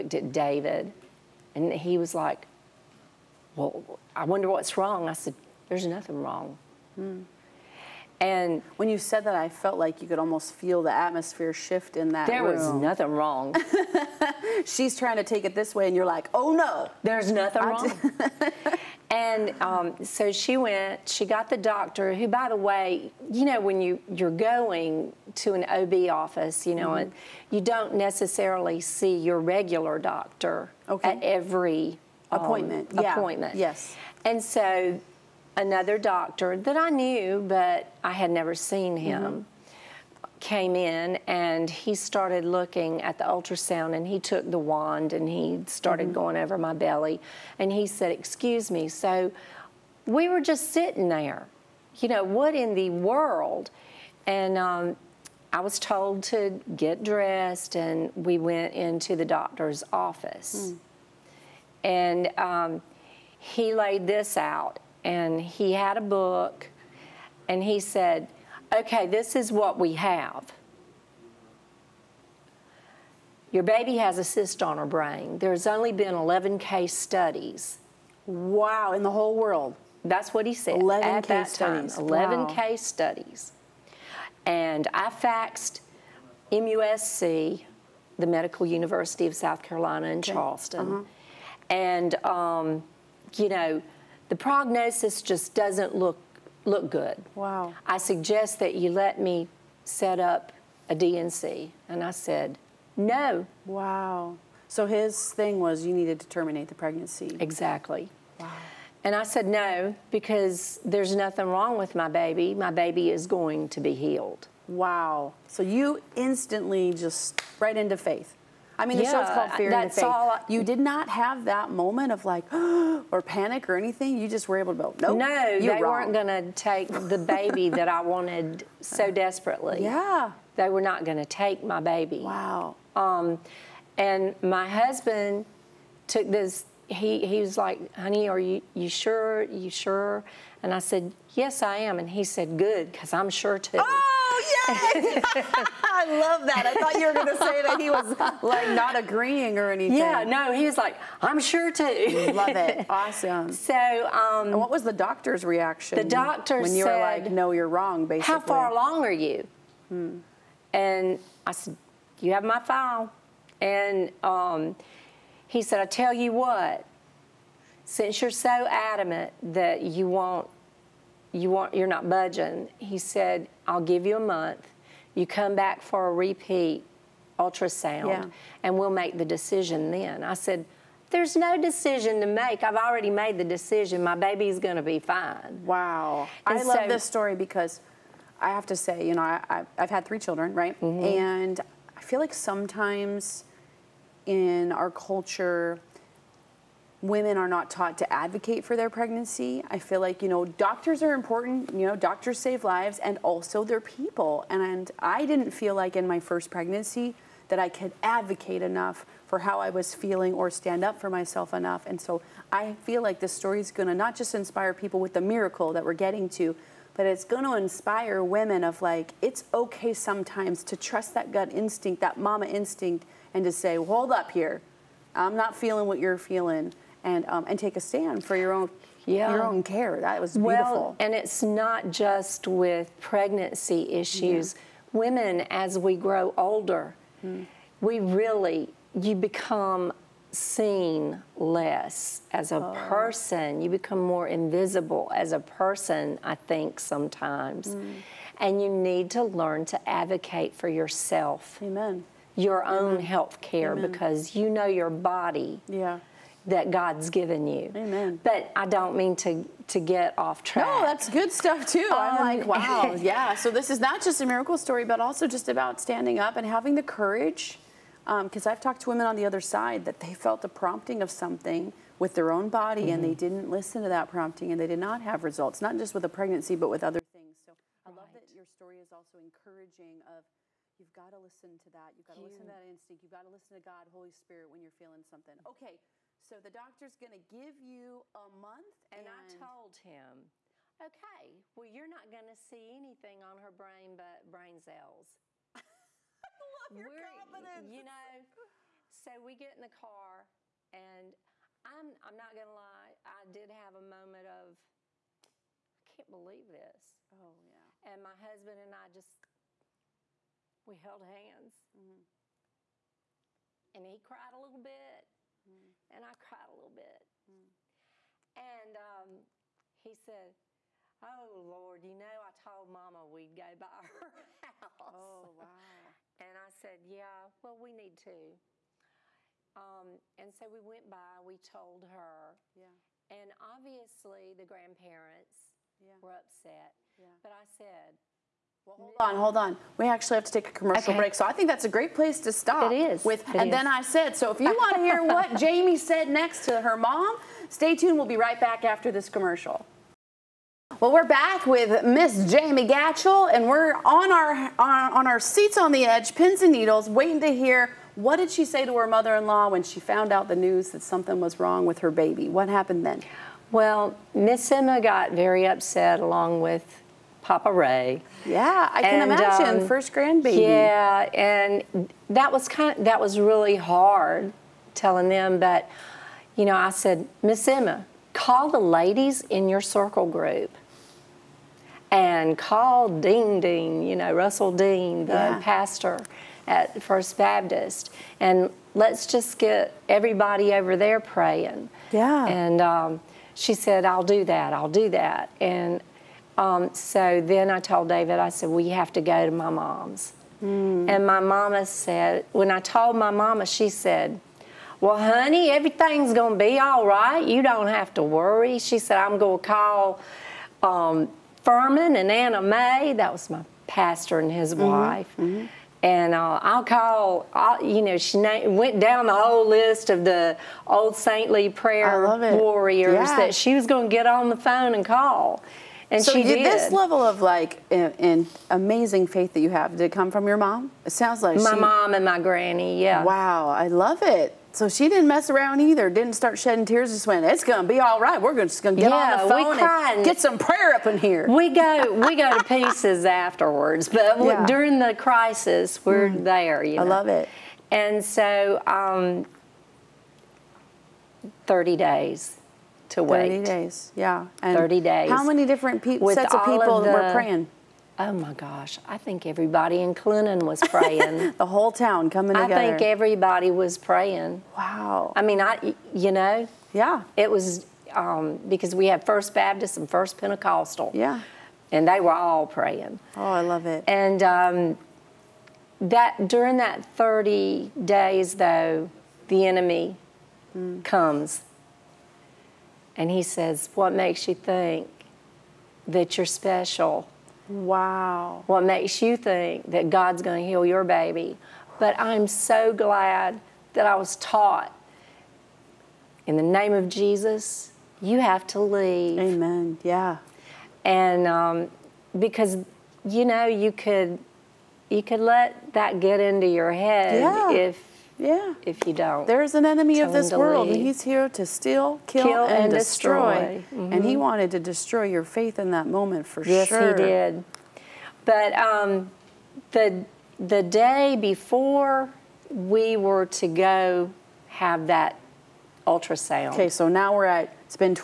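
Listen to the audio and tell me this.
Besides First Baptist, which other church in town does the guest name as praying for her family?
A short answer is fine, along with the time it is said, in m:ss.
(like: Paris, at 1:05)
First Pentecostal, at 7:49.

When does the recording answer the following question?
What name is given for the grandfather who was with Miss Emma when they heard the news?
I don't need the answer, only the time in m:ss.
6:07.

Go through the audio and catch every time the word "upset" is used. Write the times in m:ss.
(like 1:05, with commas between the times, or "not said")
5:36, 6:05.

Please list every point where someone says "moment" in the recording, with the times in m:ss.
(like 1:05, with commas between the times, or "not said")
2:01, 5:03, 8:35.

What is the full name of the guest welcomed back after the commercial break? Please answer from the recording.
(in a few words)
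Jamie Gatchell.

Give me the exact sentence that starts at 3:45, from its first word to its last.
I'm not feeling what you're feeling." and um, and take a stand for your own yeah.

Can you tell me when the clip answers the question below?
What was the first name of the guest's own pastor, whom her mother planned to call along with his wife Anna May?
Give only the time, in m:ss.
6:51.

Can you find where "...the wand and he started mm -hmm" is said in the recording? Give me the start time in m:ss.
0:44.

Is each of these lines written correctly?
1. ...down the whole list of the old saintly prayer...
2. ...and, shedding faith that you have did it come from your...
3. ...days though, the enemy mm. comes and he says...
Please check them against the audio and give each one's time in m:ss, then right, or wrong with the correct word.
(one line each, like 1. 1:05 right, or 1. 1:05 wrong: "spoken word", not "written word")
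1. 6:58 right
2. 7:07 wrong: "amazing", not "shedding"
3. 7:57 right.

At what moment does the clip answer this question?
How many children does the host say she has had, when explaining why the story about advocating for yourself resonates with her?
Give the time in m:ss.
3:10.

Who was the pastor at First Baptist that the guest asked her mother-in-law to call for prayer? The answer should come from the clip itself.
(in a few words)
Russell Dean.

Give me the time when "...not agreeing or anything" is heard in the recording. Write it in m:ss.
2:28.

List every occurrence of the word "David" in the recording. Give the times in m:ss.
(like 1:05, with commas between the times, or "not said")
0:00, 6:37.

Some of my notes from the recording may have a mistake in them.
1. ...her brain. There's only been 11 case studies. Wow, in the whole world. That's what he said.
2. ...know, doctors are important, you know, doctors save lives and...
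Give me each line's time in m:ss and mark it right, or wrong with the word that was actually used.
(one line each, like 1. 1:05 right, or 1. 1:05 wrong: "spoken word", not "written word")
1. 1:14 right
2. 3:20 right.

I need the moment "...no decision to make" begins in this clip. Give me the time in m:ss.
3:01.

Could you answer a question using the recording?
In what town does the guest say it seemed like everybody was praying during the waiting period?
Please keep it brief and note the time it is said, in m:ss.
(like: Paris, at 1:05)
Clinton, at 7:39.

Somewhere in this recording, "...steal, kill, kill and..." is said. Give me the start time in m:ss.
8:31.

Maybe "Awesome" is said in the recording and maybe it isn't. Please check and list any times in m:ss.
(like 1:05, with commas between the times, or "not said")
2:32.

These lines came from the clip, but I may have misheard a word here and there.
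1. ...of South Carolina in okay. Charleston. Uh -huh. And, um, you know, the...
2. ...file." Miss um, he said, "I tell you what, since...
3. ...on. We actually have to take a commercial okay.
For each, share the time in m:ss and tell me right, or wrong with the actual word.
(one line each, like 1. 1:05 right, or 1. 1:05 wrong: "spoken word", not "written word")
1. 1:29 right
2. 2:42 wrong: "And", not "Miss"
3. 5:39 right.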